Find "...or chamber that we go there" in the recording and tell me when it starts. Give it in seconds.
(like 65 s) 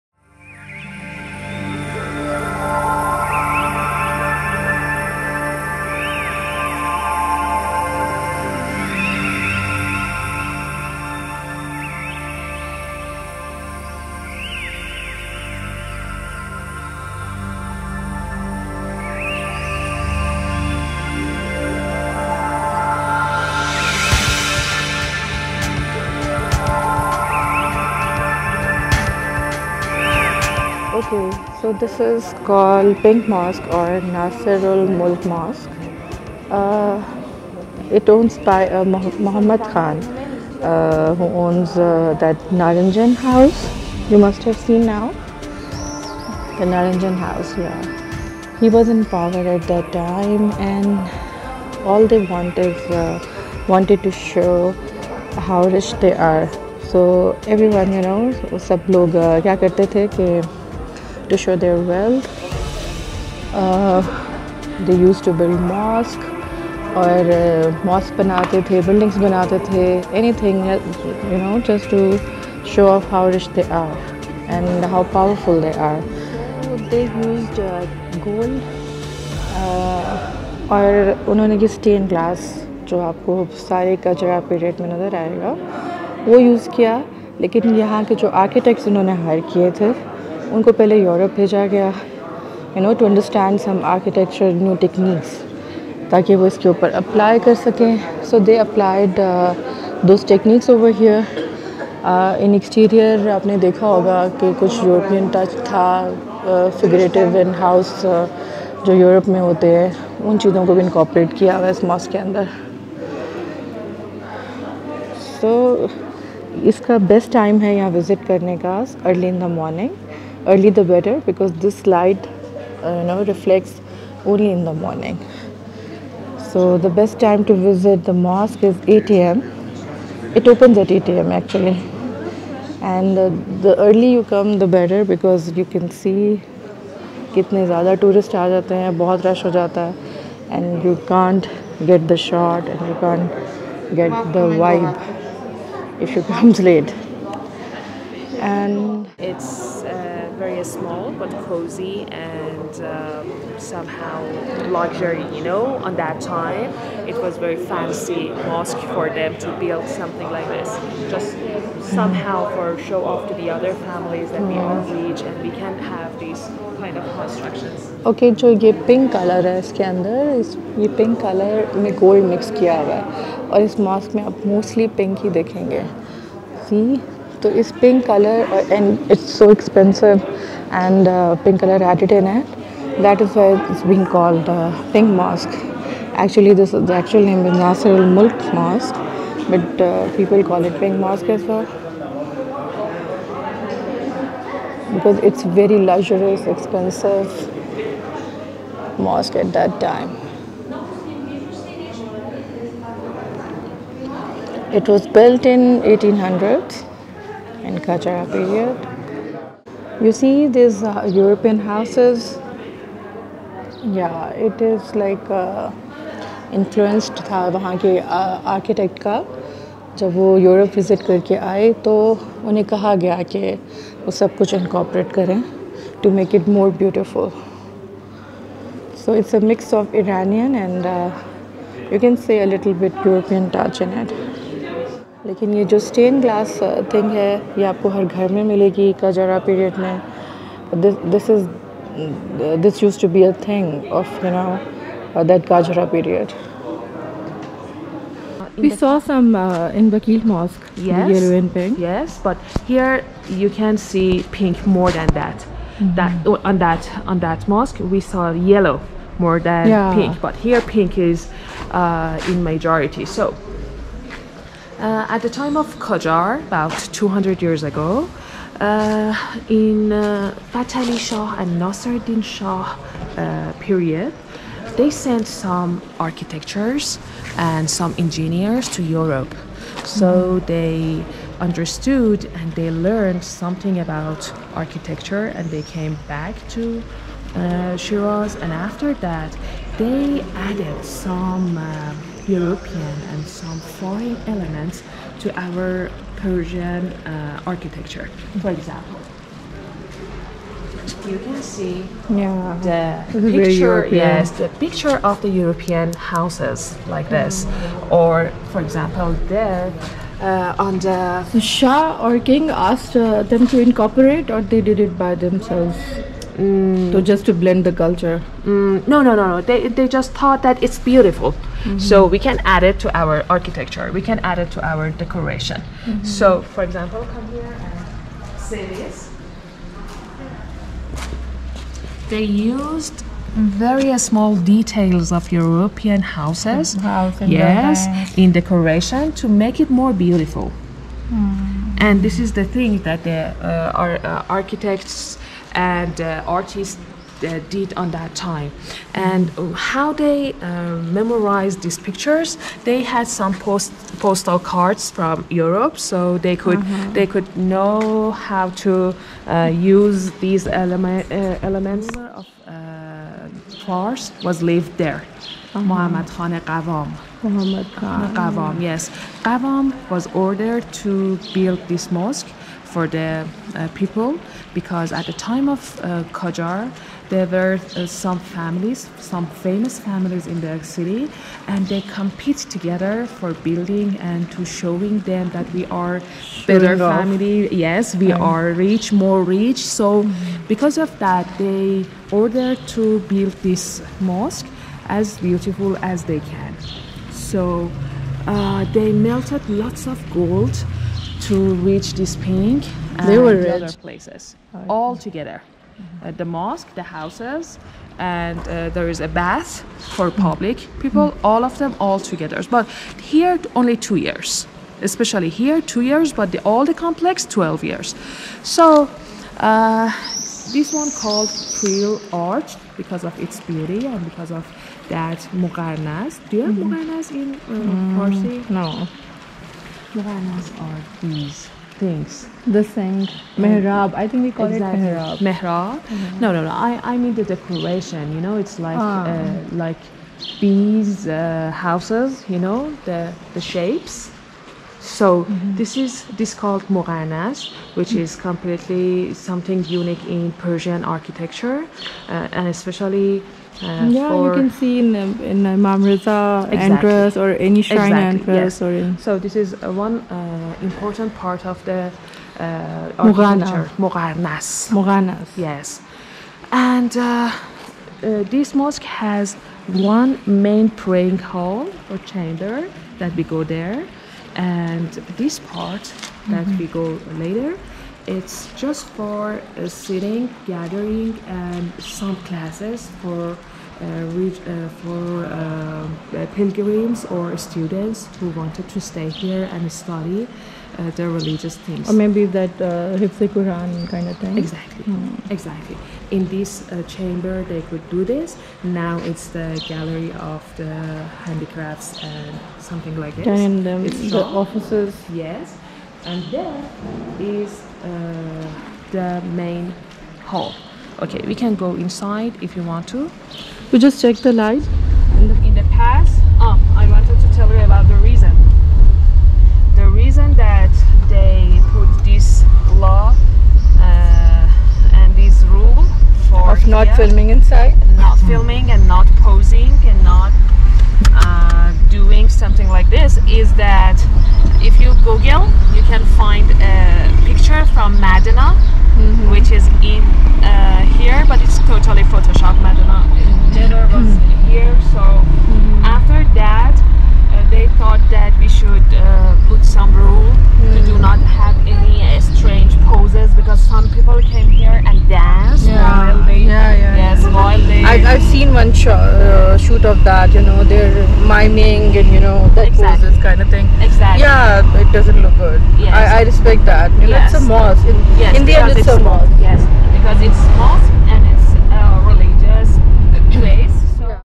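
471 s.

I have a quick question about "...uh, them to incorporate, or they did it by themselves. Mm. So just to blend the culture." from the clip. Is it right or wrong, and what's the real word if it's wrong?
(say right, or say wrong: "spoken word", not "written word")
right.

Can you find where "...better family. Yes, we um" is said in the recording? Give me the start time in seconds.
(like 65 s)
386 s.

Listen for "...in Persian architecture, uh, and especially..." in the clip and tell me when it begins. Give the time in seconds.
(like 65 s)
450 s.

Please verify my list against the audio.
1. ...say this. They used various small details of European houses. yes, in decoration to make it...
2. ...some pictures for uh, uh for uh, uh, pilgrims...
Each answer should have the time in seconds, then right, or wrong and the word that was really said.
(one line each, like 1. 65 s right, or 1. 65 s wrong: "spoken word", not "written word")
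1. 328 s right
2. 481 s wrong: "classes", not "pictures".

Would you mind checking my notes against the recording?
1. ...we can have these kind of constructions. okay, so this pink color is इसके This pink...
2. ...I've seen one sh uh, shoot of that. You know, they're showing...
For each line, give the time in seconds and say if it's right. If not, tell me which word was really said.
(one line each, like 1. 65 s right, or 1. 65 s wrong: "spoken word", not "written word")
1. 165 s right
2. 558 s wrong: "miming", not "showing".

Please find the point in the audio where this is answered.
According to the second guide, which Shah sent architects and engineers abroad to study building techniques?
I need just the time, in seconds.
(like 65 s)
271 s.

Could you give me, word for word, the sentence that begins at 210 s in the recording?
You see these uh, European houses?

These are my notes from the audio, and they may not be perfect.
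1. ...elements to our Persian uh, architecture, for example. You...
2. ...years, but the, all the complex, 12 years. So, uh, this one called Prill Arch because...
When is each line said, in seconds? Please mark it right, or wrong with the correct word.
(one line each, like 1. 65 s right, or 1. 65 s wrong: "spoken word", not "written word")
1. 294 s right
2. 415 s right.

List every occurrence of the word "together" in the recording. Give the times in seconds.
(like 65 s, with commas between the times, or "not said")
382 s, 404 s, 411 s.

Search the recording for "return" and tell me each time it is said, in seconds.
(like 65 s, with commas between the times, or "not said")
not said.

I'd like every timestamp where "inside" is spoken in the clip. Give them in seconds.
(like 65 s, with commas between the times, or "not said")
511 s, 527 s.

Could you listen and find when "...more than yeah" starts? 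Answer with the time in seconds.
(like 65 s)
259 s.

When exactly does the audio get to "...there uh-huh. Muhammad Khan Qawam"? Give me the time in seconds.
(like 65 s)
364 s.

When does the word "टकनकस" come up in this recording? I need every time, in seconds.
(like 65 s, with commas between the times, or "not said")
94 s, 100 s.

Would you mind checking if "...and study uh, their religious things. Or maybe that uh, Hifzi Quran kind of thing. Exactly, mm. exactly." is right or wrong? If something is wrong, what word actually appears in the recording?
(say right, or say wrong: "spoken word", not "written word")
right.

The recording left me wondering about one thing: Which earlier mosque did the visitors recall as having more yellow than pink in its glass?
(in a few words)
Vakil Mosque.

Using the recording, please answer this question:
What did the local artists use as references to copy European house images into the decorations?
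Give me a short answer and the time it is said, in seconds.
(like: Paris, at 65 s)
postal cards, at 353 s.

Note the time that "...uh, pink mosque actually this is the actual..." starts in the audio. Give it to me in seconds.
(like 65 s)
184 s.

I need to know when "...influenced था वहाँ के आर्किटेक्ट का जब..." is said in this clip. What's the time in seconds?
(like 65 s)
216 s.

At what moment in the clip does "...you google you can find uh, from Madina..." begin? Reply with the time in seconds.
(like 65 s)
534 s.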